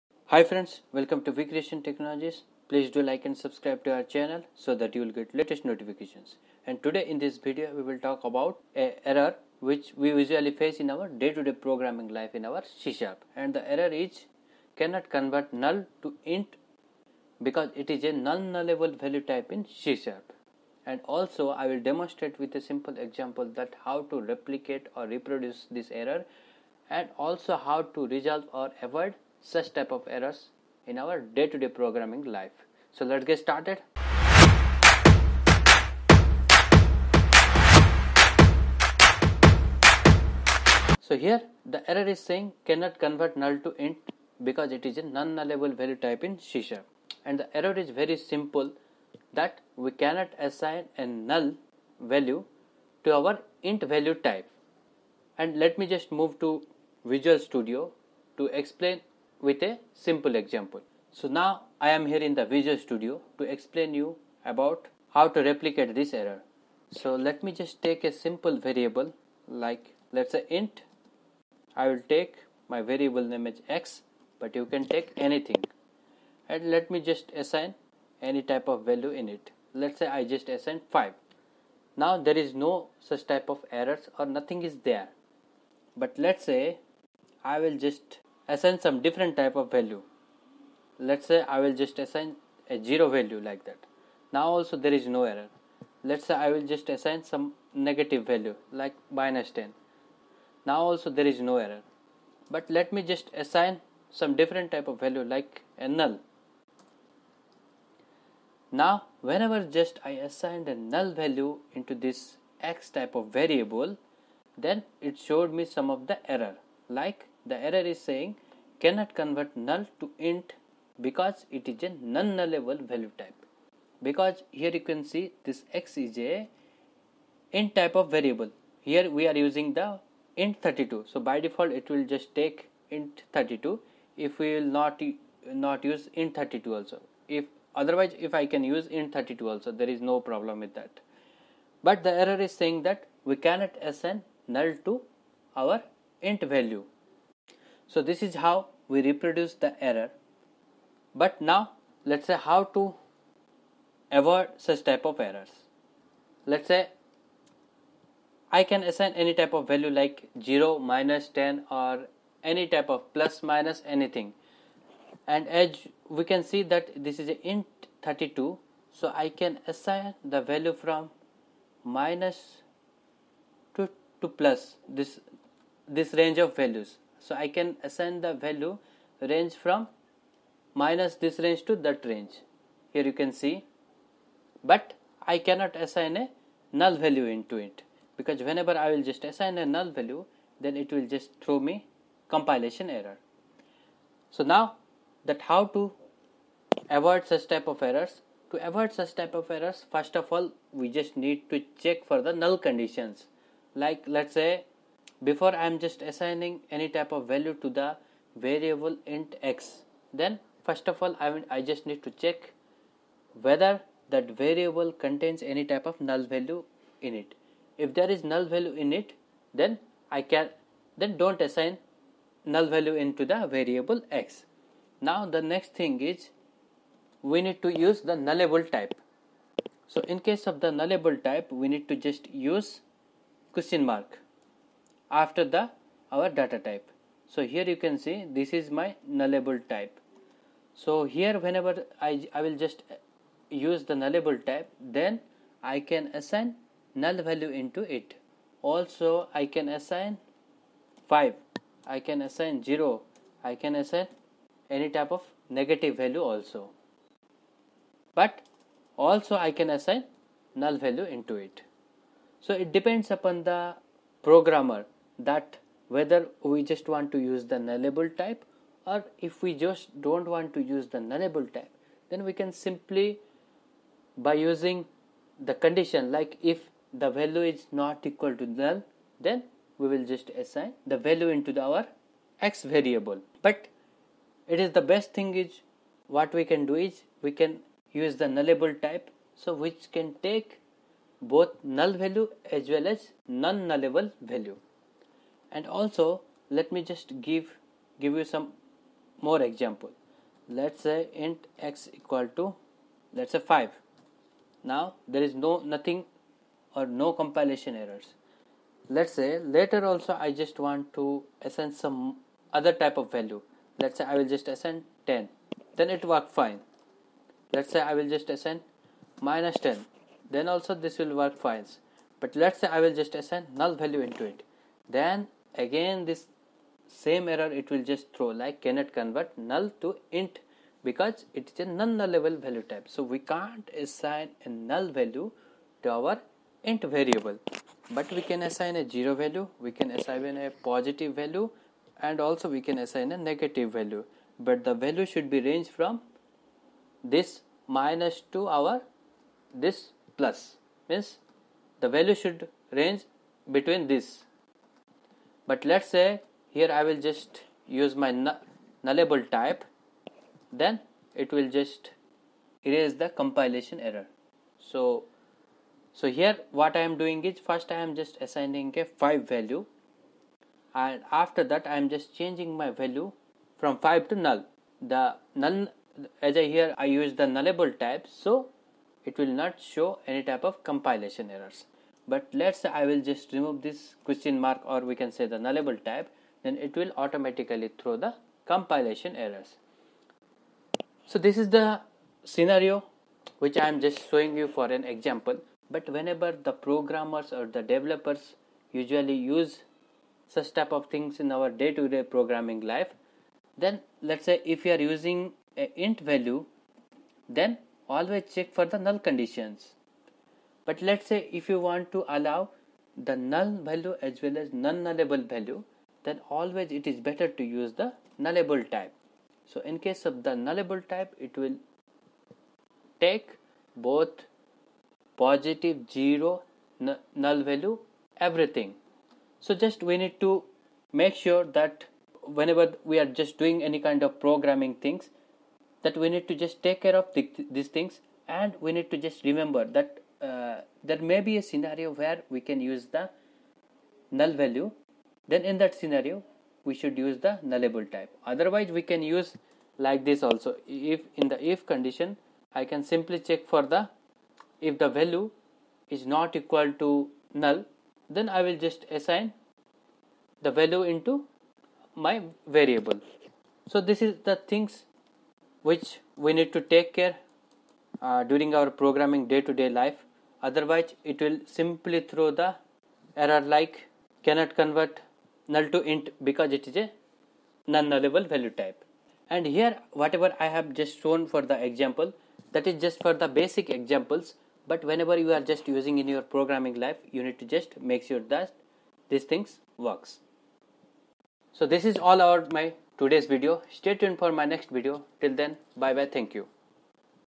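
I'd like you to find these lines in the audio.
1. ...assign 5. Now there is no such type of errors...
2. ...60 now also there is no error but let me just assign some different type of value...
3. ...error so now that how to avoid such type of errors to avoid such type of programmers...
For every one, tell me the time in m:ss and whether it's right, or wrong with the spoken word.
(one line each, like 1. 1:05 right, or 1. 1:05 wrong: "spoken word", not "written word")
1. 1:20 right
2. 1:39 wrong: "10", not "60"
3. 3:12 wrong: "errors", not "programmers".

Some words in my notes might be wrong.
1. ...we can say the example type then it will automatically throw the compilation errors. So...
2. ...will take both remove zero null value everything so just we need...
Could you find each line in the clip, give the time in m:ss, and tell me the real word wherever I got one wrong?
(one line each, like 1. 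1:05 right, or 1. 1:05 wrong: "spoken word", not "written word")
1. 6:24 wrong: "nullable", not "example"
2. 7:01 wrong: "positive", not "remove".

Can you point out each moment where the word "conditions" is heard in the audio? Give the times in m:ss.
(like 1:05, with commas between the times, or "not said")
3:22, 4:35, 6:48, 7:31.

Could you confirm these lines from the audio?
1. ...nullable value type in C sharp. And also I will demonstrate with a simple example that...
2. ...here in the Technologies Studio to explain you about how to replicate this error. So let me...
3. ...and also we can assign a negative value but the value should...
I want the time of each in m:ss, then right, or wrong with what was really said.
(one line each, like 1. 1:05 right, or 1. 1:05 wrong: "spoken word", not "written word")
1. 0:18 right
2. 1:02 wrong: "Visual", not "Technologies"
3. 5:42 right.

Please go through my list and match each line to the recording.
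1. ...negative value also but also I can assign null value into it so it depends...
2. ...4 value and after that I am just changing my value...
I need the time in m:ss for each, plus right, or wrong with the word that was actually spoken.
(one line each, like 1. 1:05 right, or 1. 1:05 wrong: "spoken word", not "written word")
1. 4:15 right
2. 6:09 wrong: "5", not "4".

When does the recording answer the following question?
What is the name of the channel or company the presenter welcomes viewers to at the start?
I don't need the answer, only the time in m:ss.
0:01.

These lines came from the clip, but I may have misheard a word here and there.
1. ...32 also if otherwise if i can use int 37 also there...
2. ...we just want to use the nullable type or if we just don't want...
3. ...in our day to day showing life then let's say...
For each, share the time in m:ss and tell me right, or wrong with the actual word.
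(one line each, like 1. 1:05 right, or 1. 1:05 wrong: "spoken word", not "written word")
1. 2:16 wrong: "32", not "37"
2. 4:26 right
3. 6:41 wrong: "programming", not "showing".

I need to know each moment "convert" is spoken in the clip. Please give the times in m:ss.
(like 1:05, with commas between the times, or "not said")
0:15, 0:42, 1:59, 5:28, 7:54.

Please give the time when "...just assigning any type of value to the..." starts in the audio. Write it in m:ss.
3:25.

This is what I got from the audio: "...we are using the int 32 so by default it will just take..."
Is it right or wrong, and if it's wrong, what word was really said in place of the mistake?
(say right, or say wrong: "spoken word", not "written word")
right.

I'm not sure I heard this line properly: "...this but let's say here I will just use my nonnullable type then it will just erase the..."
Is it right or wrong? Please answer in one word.
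wrong.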